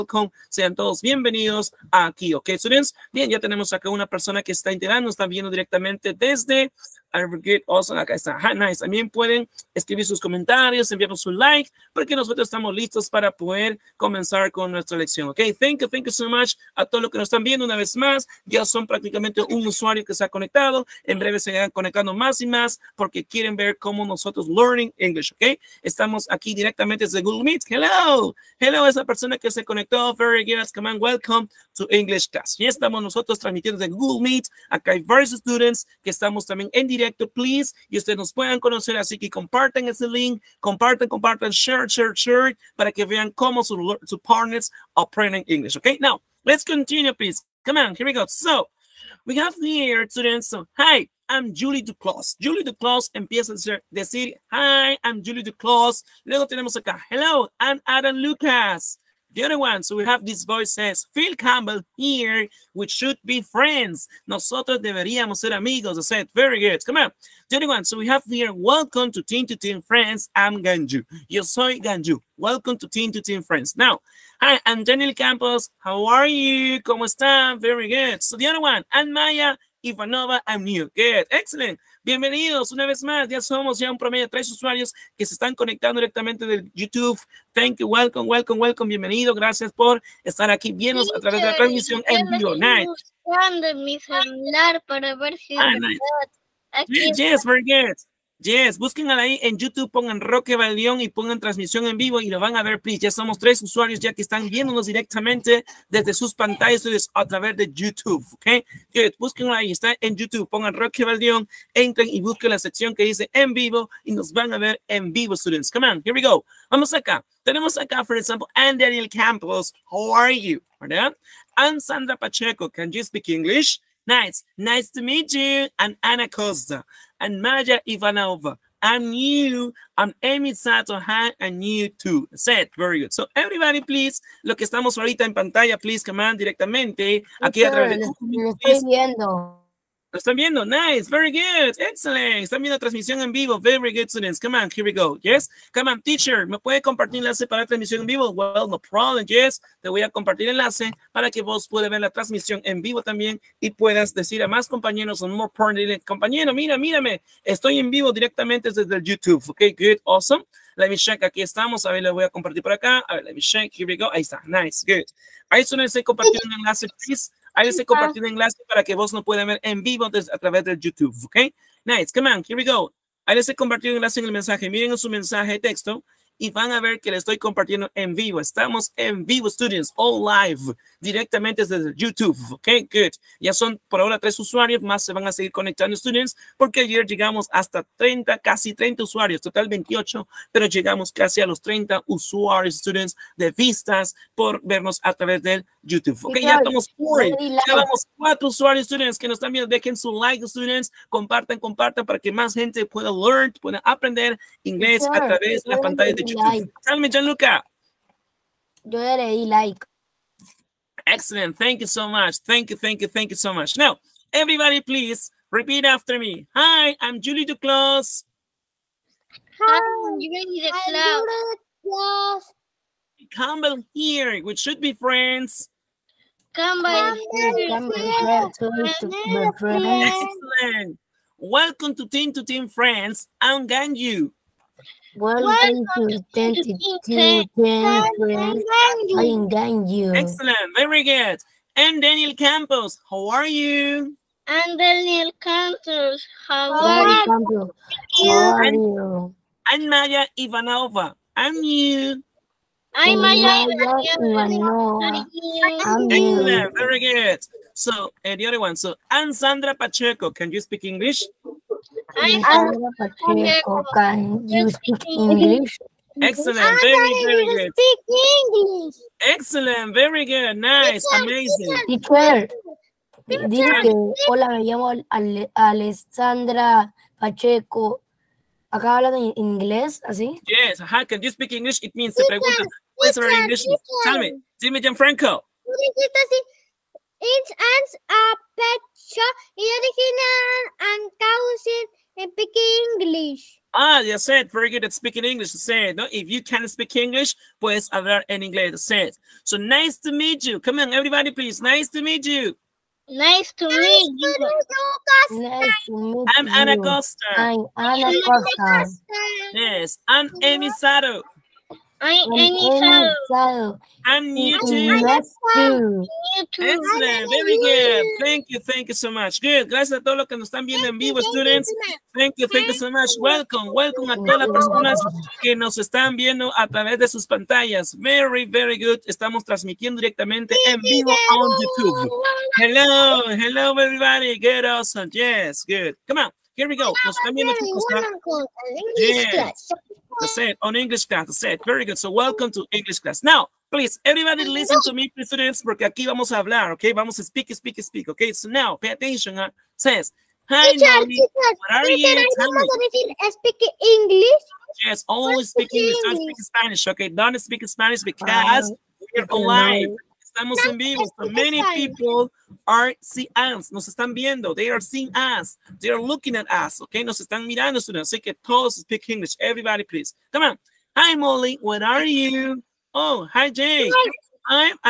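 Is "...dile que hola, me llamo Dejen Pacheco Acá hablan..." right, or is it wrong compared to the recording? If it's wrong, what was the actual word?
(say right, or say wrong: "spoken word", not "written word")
wrong: "Alessandra", not "Dejen".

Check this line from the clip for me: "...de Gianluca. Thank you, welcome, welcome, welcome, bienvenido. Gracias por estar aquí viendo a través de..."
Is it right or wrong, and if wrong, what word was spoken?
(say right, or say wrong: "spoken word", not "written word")
wrong: "YouTube", not "Gianluca".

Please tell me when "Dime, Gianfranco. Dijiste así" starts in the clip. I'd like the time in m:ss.
4:44.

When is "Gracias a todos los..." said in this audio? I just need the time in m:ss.
5:19.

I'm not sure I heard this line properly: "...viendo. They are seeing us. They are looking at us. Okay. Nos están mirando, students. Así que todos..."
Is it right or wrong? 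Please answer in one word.
right.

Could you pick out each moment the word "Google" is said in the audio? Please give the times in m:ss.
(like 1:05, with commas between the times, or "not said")
0:27, 0:33.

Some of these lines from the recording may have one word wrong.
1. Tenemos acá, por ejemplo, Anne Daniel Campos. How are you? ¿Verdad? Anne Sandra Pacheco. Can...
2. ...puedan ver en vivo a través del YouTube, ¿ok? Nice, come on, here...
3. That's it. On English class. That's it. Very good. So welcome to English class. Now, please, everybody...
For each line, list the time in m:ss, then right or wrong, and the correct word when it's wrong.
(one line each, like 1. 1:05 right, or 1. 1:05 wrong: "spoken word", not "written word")
1. 1:57 right
2. 2:49 right
3. 5:40 right.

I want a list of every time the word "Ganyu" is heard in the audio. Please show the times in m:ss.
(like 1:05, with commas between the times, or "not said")
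3:53, 3:59.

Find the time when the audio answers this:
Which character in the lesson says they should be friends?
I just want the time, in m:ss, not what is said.
1:01.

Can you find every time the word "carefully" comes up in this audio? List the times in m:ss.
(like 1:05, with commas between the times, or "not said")
not said.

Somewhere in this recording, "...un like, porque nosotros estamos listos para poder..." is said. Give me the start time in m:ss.
0:11.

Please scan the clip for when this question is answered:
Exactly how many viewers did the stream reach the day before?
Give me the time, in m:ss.
3:09.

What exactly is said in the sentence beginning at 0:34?
Acá hay varios students que estamos también en directo please, y ustedes nos puedan conocer.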